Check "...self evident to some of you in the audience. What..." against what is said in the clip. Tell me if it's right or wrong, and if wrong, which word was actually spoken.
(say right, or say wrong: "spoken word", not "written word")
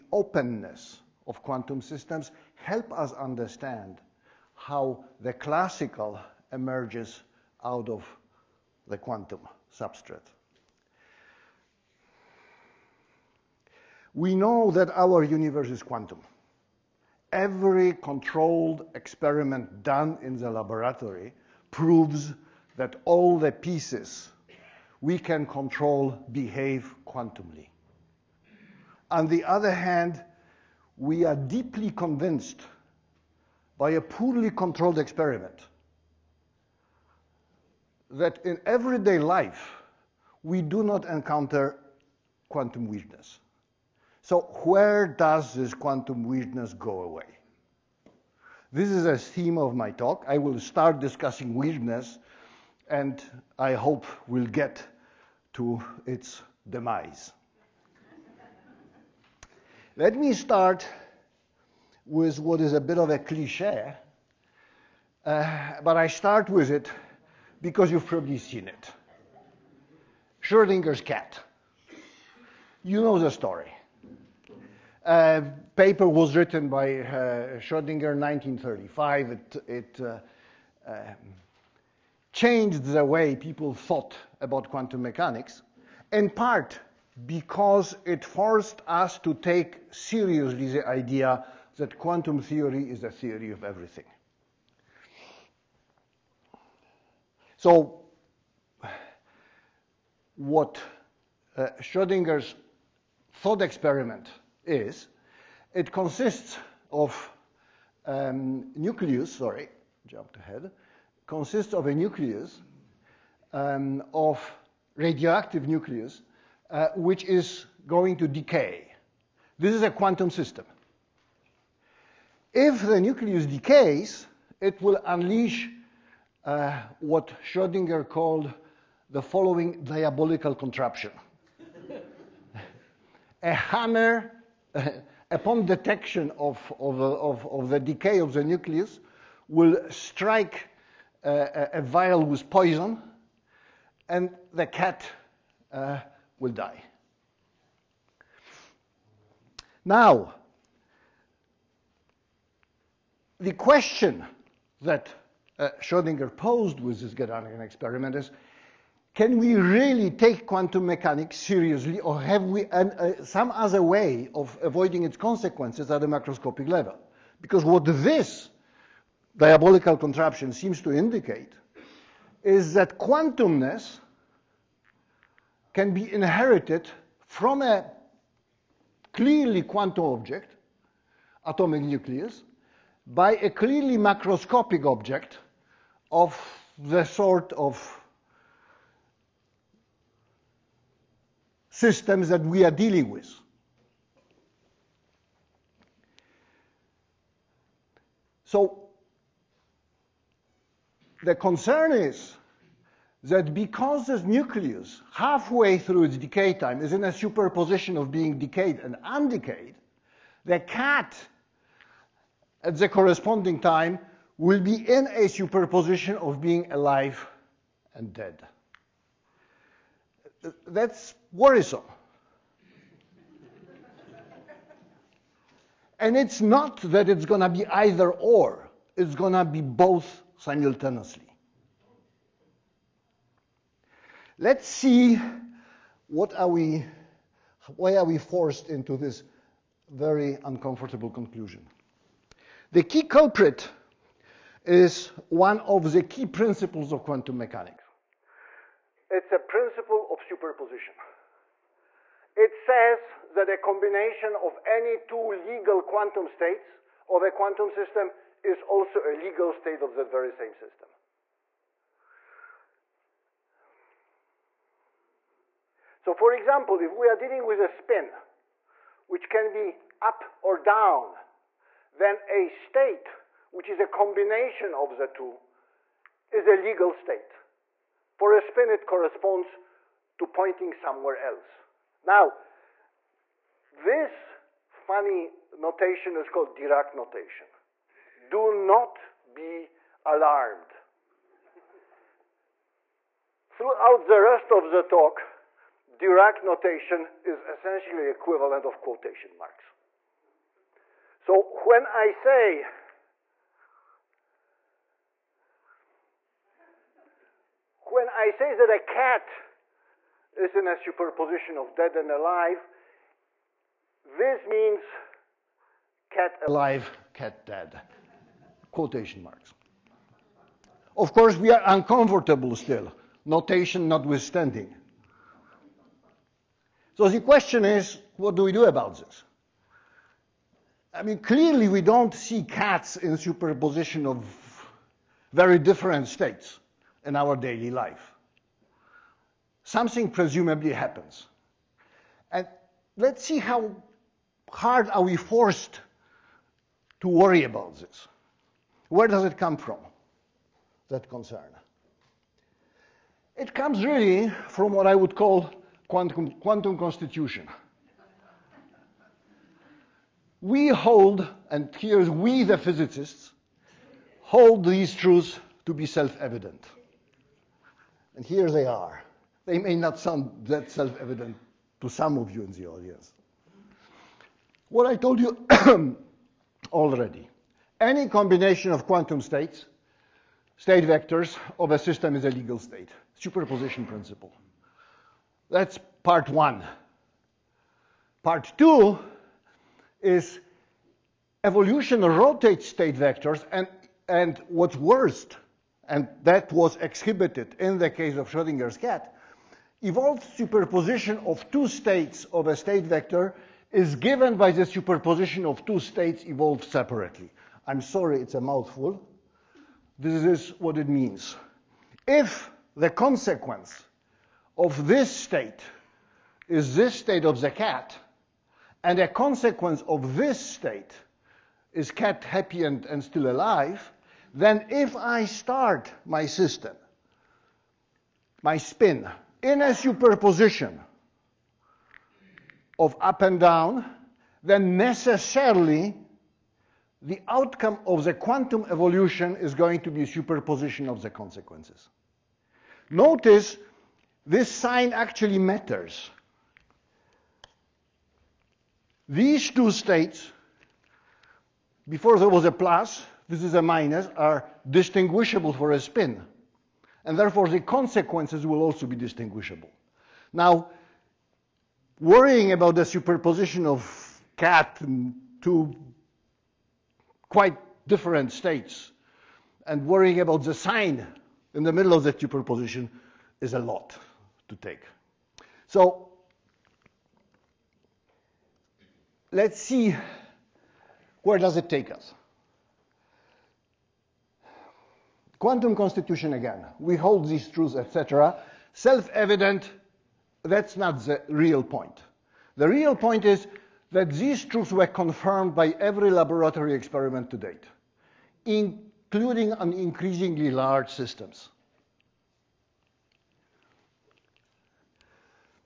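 right.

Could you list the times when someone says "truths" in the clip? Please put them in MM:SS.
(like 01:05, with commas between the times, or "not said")
06:04, 08:07, 08:14.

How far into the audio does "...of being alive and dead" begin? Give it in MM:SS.
03:36.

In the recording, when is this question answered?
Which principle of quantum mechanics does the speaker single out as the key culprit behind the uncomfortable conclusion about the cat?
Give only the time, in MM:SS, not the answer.
04:09.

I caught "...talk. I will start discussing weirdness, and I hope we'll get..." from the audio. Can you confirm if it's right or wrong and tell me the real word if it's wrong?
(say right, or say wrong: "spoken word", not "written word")
right.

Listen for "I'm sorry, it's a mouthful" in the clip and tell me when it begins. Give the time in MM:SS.
06:47.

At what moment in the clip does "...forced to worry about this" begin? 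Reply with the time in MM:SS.
05:45.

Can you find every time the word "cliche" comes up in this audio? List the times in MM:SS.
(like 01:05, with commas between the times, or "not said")
01:03.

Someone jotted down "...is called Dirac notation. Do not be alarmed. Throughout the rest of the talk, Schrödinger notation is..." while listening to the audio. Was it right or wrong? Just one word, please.
wrong.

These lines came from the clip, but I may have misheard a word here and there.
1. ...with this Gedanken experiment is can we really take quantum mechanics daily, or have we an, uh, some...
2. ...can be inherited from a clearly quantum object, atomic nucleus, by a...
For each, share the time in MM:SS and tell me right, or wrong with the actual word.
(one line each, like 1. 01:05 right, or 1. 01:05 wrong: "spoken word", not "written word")
1. 02:36 wrong: "seriously", not "daily"
2. 02:55 right.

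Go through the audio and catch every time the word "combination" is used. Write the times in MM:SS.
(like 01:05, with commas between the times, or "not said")
04:13, 04:33, 06:18.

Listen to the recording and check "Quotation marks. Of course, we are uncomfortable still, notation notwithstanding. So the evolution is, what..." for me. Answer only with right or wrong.
wrong.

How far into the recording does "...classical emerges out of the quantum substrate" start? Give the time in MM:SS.
00:05.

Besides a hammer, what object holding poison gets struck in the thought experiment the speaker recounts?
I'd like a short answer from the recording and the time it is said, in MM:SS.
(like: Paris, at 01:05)
A vial, at 02:21.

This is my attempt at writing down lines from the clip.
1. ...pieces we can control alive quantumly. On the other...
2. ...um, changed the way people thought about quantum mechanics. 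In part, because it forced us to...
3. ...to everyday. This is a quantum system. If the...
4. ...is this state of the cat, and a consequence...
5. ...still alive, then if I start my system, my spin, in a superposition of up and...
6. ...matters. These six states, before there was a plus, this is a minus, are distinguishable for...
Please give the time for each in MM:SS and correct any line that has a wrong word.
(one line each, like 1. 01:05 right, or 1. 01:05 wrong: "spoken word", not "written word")
1. 00:23 wrong: "behave", not "alive"
2. 01:20 right
3. 01:58 wrong: "decay", not "everyday"
4. 06:56 right
5. 07:03 right
6. 07:25 wrong: "two", not "six".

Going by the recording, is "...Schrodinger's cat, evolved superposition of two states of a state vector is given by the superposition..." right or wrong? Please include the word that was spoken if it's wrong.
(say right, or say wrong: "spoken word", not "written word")
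right.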